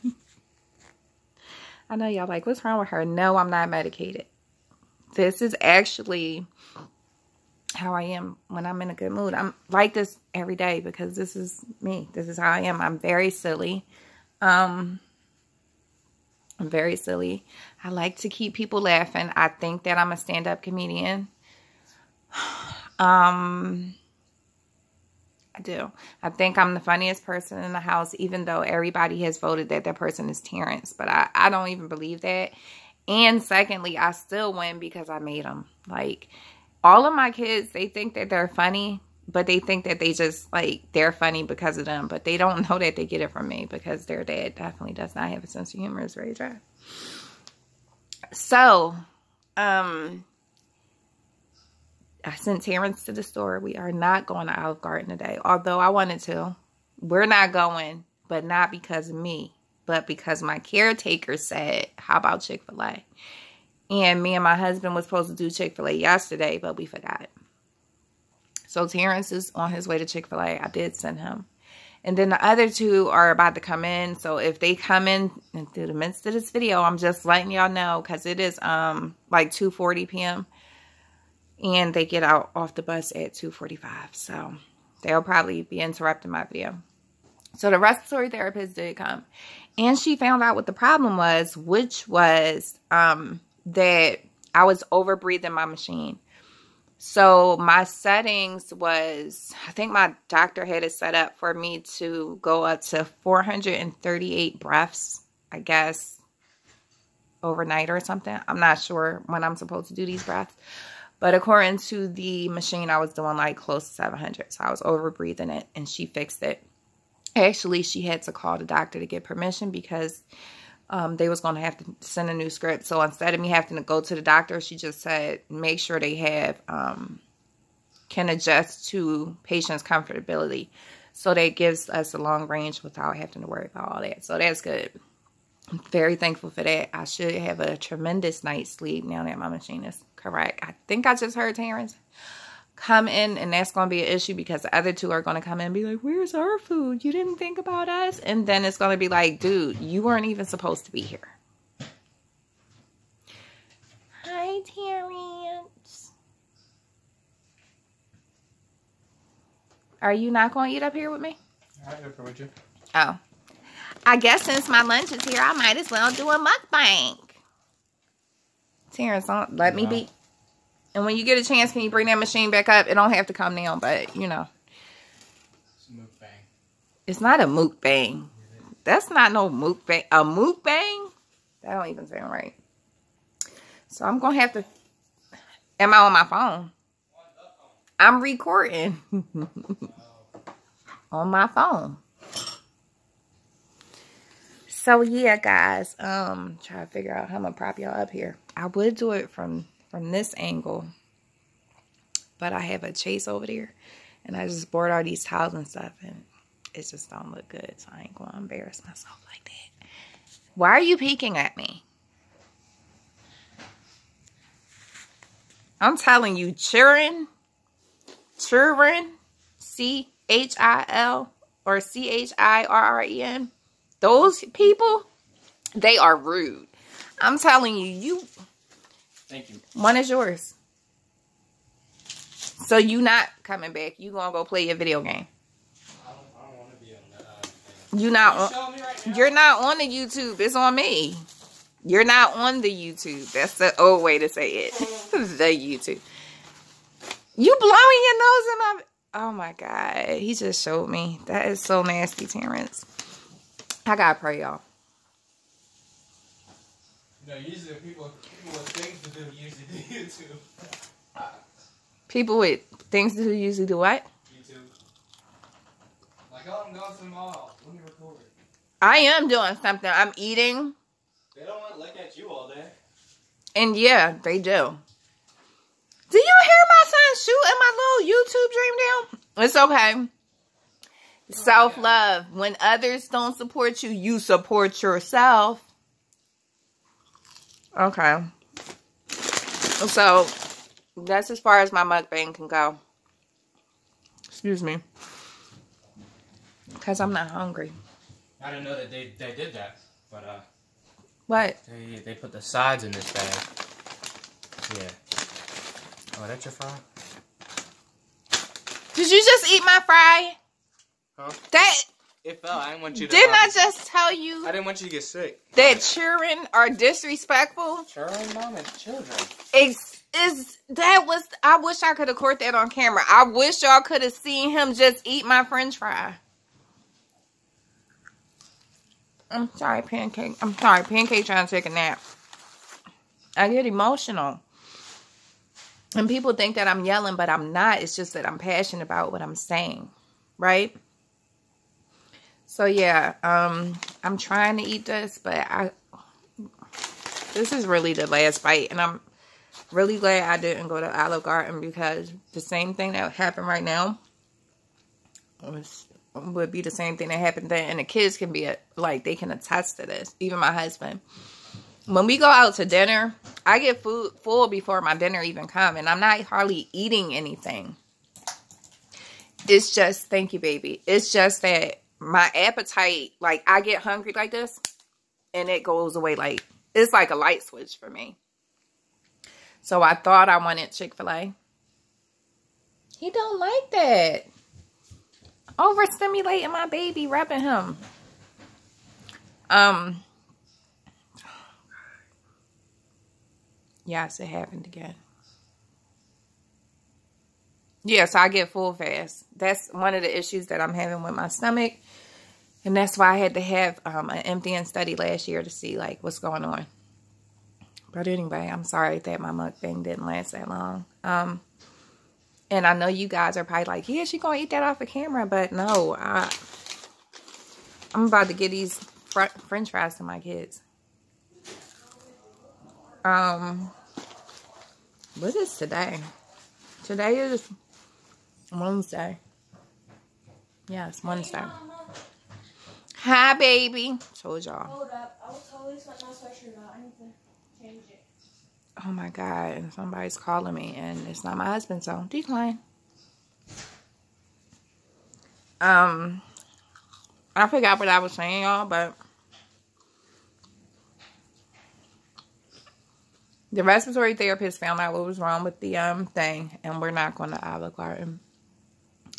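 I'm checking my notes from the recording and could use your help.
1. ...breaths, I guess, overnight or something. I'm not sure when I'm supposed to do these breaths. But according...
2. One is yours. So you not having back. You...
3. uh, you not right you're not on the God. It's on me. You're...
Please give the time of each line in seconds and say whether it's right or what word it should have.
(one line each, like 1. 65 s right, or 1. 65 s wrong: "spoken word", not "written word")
1. 104 s right
2. 229 s wrong: "coming", not "having"
3. 237 s wrong: "YouTube", not "God".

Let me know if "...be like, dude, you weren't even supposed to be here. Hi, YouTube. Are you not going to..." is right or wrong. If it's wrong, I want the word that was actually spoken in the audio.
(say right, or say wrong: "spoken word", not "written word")
wrong: "Terrence", not "YouTube".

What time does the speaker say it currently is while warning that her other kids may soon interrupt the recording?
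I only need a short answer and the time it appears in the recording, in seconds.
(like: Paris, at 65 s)
2:40 p.m., at 79 s.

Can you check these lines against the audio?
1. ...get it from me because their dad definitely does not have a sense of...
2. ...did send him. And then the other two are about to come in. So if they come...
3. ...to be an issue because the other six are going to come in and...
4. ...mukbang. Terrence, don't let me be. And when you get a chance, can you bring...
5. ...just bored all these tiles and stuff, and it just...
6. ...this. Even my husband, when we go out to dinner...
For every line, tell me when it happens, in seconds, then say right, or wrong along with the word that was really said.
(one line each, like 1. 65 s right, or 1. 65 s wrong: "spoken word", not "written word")
1. 43 s right
2. 70 s right
3. 143 s wrong: "two", not "six"
4. 166 s right
5. 204 s right
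6. 359 s right.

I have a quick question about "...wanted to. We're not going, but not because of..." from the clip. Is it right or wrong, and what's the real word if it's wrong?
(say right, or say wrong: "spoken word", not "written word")
right.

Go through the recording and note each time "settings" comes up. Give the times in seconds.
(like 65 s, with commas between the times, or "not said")
97 s.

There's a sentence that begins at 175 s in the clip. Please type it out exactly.
It's, it's not a mook bang.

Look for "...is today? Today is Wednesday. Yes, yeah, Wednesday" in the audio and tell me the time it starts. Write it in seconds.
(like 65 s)
425 s.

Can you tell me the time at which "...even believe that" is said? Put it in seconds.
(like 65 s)
31 s.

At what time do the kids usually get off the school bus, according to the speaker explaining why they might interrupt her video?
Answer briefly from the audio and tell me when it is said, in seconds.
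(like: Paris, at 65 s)
2:45, at 83 s.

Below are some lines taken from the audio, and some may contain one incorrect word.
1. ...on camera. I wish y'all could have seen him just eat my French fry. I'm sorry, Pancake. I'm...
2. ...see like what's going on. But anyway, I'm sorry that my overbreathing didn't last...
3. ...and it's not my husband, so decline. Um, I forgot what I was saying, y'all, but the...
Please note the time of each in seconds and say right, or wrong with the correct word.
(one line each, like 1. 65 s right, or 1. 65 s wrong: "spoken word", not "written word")
1. 322 s right
2. 405 s wrong: "mukbang", not "overbreathing"
3. 440 s right.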